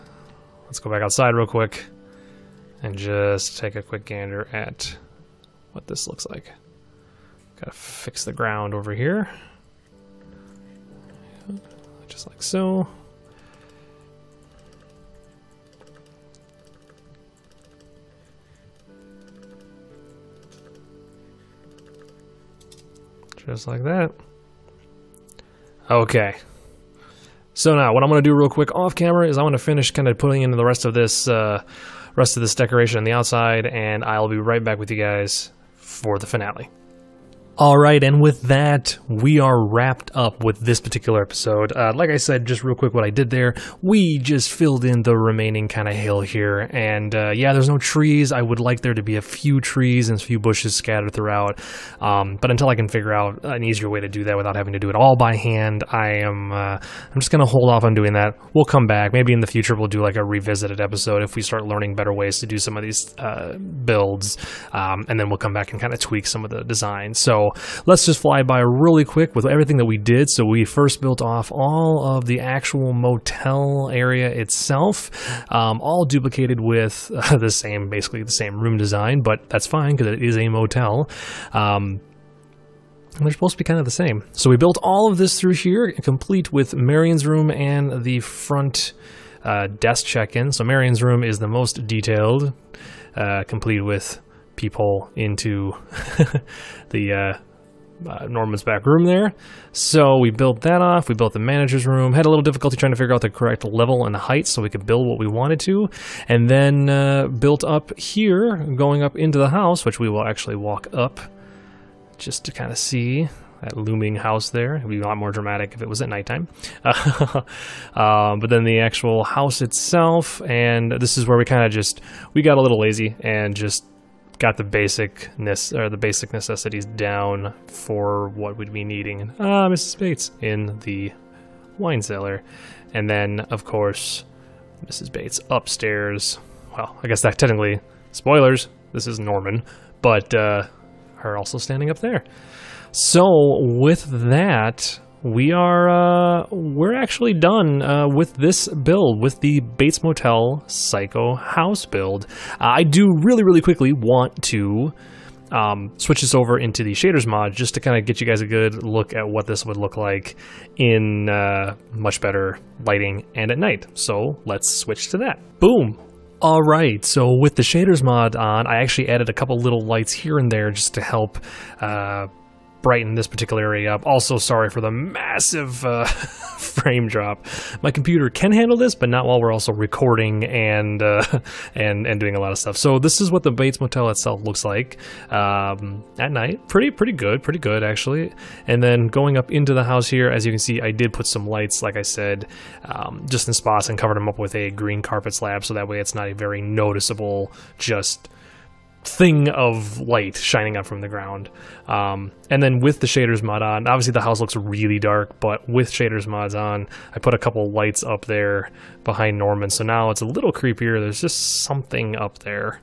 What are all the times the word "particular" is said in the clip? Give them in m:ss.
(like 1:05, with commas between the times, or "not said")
0:40, 2:53.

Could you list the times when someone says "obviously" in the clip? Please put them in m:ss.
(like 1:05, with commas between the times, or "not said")
3:23.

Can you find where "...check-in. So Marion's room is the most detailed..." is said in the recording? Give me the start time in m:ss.
1:30.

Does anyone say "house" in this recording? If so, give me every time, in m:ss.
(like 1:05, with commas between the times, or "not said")
1:49, 1:54, 1:59, 2:31, 3:09, 3:24.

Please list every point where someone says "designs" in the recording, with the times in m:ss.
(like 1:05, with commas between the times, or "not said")
1:06, 1:18.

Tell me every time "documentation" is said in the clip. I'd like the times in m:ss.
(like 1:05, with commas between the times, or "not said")
not said.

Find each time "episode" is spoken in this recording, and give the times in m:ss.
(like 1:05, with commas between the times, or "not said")
0:41, 1:00.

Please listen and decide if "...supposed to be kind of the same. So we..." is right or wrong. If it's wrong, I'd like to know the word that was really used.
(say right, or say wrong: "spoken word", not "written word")
right.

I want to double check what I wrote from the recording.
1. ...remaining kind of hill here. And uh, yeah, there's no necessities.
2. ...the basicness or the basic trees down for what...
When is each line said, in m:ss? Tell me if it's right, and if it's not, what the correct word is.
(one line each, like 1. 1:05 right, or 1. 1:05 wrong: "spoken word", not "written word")
1. 0:45 wrong: "trees", not "necessities"
2. 2:04 wrong: "necessities", not "trees".